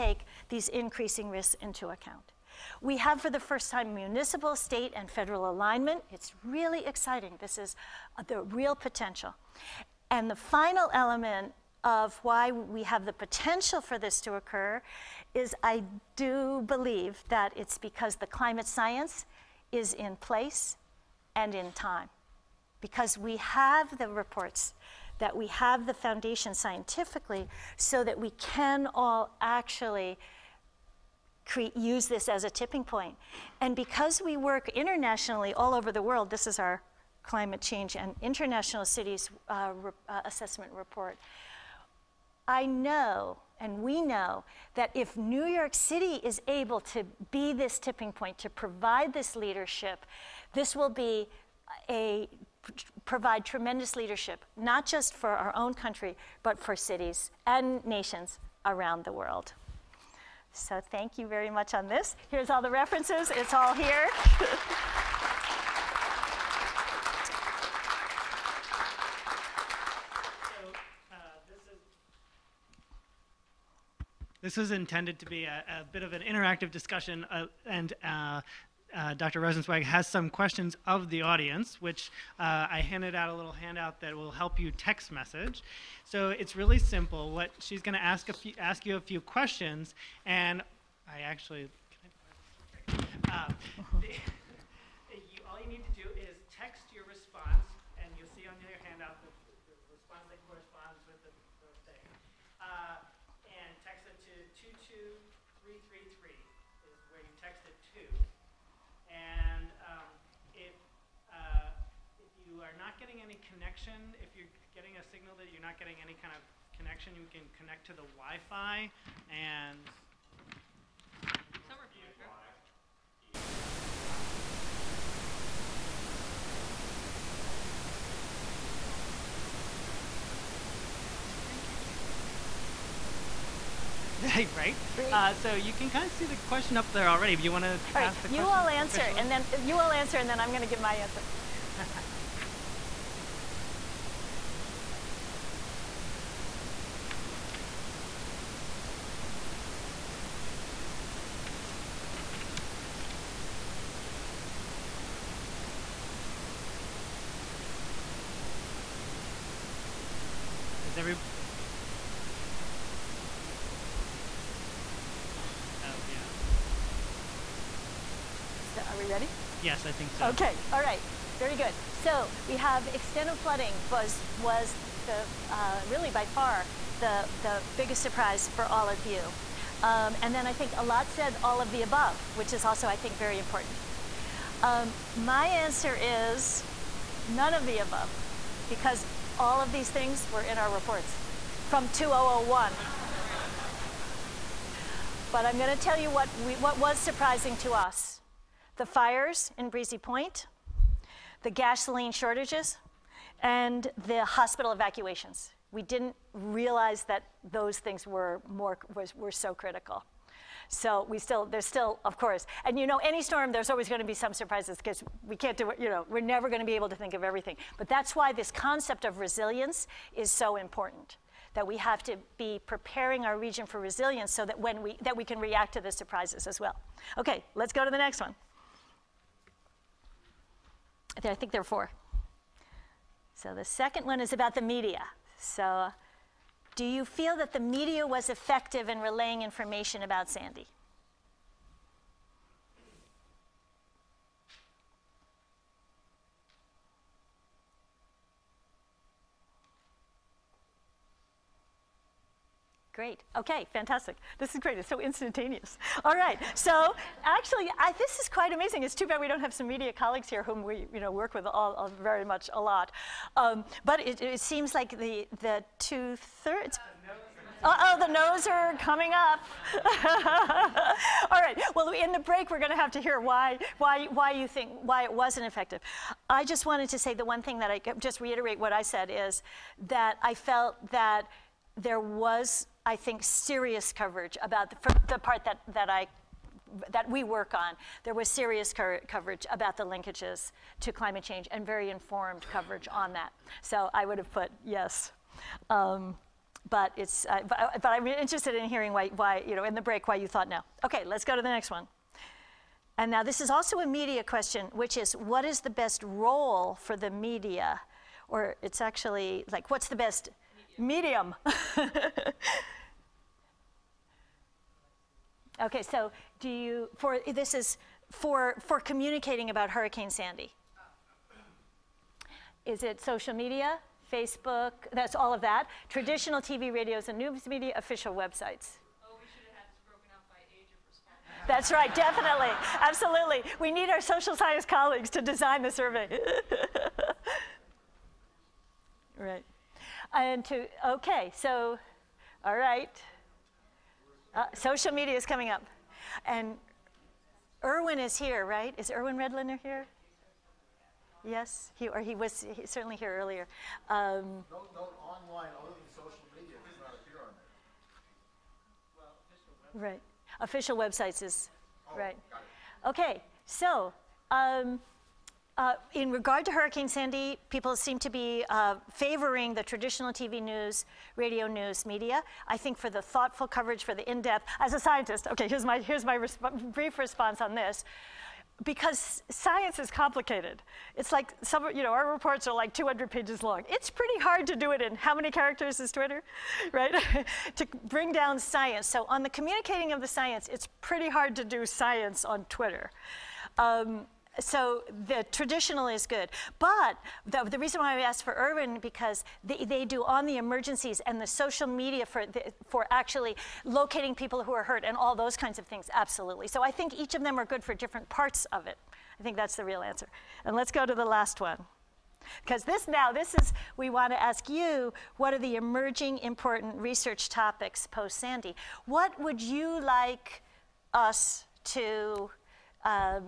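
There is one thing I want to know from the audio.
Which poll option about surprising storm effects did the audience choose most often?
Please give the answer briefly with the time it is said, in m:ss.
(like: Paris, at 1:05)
Extended flooding, at 2:52.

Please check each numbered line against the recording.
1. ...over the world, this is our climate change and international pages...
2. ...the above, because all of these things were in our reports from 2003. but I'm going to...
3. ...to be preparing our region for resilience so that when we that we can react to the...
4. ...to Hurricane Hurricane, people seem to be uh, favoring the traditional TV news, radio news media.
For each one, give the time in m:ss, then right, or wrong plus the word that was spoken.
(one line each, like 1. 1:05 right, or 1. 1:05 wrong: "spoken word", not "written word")
1. 0:35 wrong: "cities", not "pages"
2. 3:07 wrong: "2001", not "2003"
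3. 3:42 right
4. 6:06 wrong: "Sandy", not "Hurricane".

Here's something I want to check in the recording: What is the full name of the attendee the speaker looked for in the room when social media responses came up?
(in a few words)
Irwin Redlener.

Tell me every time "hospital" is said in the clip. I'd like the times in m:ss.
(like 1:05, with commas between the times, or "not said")
3:24.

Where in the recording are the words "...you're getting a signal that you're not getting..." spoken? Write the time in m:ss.
1:54.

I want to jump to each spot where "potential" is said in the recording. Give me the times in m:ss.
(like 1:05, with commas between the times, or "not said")
0:08, 0:13.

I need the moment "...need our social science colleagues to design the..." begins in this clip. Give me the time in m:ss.
5:33.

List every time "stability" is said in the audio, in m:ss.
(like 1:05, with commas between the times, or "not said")
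not said.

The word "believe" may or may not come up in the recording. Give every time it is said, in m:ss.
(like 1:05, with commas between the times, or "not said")
0:16.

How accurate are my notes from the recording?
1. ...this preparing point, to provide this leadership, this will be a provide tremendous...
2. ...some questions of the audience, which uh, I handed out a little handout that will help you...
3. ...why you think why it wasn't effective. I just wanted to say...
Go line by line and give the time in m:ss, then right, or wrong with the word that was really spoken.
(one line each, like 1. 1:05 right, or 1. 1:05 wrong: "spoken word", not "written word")
1. 0:47 wrong: "tipping", not "preparing"
2. 1:20 right
3. 4:34 right.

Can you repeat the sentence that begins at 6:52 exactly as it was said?
Because this now, this is, we want to ask you, what are the emerging important research topics post Sandy?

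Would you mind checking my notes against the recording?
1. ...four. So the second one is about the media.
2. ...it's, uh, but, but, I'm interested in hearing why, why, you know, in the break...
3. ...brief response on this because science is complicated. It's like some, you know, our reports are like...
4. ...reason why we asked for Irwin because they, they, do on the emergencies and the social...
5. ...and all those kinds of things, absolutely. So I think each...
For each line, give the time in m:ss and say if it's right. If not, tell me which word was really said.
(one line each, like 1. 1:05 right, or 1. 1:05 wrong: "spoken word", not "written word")
1. 3:51 right
2. 4:56 right
3. 6:16 right
4. 6:37 right
5. 6:44 right.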